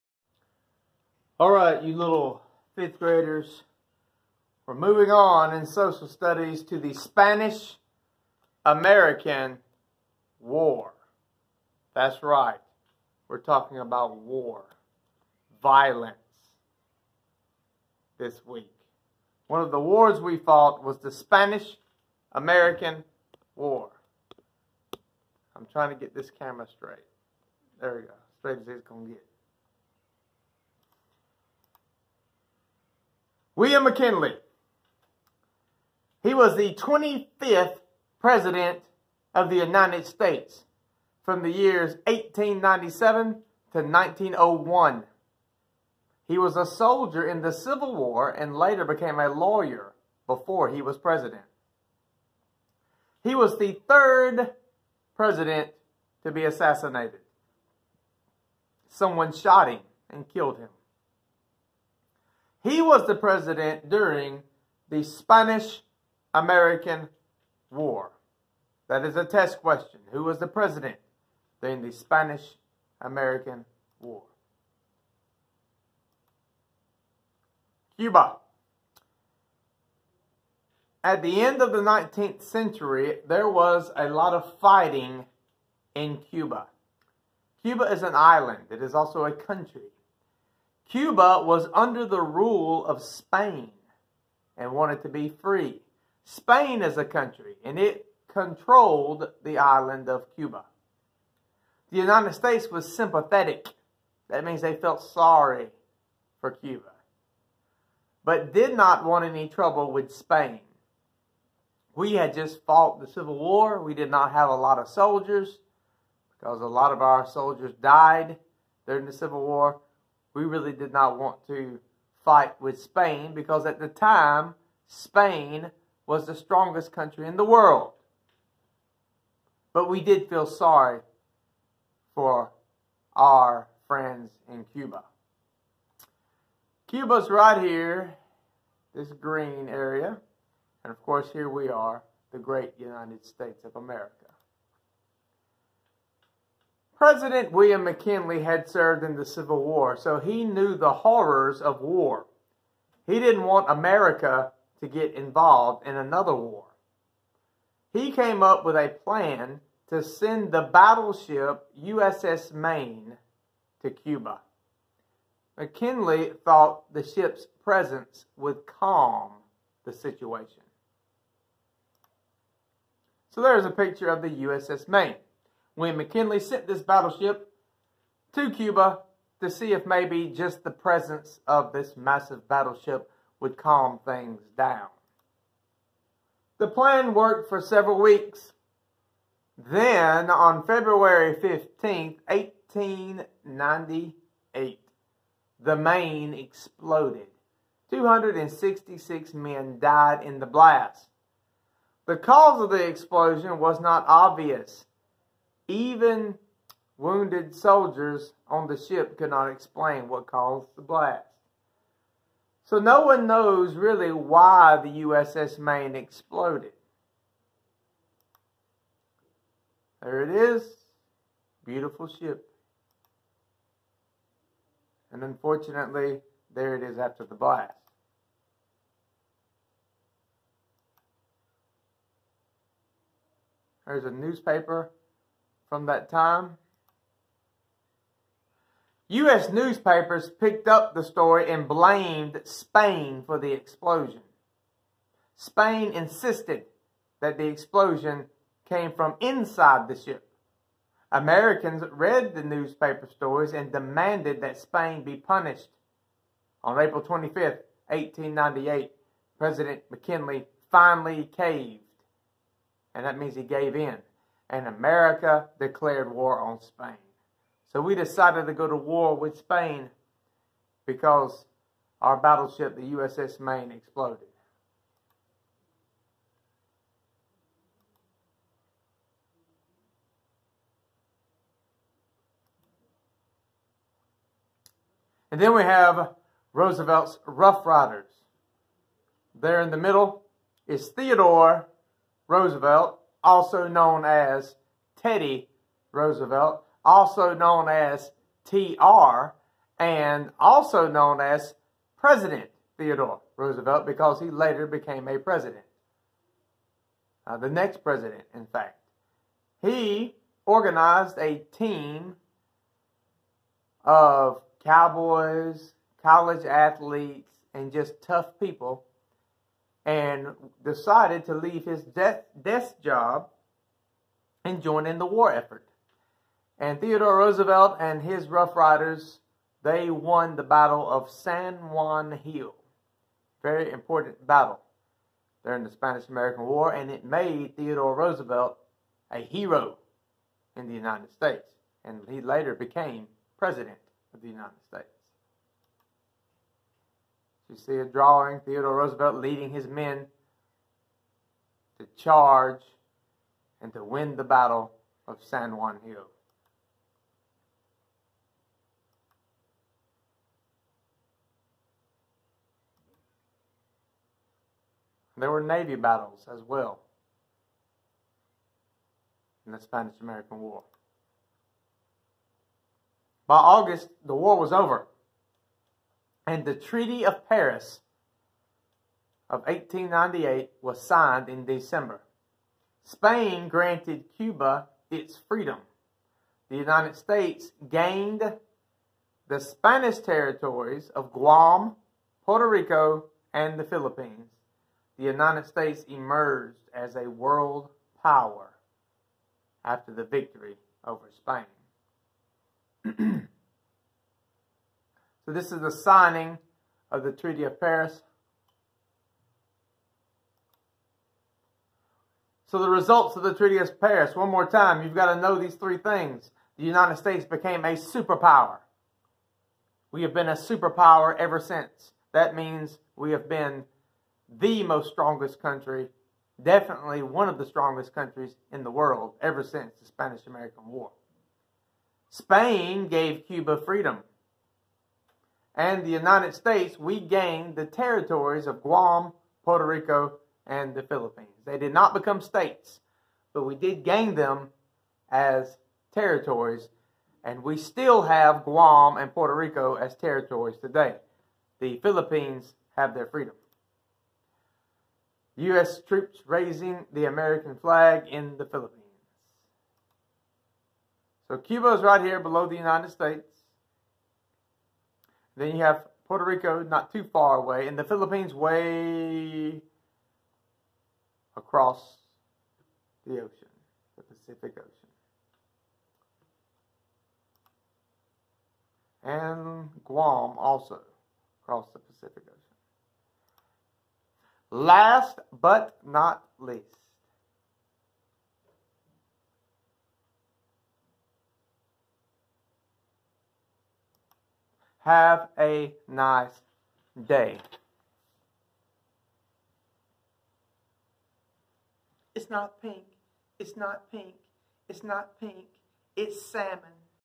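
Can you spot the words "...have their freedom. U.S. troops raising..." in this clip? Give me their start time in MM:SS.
07:32.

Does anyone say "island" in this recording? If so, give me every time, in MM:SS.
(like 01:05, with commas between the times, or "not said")
01:28, 01:39.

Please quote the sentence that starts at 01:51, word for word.
We had just fought the Civil War.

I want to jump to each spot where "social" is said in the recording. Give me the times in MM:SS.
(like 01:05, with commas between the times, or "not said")
00:05.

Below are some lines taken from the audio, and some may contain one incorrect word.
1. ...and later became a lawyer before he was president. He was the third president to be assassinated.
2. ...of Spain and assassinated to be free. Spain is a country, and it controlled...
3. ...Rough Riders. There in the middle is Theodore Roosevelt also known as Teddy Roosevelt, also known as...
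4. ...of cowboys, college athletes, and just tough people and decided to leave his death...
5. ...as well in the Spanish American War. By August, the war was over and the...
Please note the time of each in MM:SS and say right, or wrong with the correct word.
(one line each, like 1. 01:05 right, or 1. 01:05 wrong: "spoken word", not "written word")
1. 00:48 right
2. 01:32 wrong: "wanted", not "assassinated"
3. 04:47 right
4. 05:13 right
5. 06:06 right.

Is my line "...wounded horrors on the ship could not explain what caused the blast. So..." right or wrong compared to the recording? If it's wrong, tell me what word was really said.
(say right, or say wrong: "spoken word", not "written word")
wrong: "soldiers", not "horrors".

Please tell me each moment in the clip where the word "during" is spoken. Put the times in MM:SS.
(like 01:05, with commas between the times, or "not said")
01:03, 01:11, 01:58, 05:35.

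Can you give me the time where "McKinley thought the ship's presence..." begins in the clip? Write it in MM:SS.
02:45.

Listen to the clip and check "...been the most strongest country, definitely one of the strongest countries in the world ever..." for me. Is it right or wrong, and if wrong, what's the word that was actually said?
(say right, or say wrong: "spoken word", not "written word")
right.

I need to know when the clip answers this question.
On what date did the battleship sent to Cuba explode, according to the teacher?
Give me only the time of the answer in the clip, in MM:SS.
03:10.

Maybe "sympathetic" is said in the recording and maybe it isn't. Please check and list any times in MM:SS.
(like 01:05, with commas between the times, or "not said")
01:42.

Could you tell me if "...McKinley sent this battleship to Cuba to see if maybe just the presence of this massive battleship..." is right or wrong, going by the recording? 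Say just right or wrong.
right.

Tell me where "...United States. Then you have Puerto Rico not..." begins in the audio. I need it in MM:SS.
07:42.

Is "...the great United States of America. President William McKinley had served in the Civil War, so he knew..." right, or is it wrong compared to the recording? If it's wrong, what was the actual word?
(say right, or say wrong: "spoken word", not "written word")
right.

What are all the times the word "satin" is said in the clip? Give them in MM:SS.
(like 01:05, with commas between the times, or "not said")
not said.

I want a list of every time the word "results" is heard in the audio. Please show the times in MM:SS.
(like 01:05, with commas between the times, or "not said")
06:52.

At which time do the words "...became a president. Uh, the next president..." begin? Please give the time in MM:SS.
05:04.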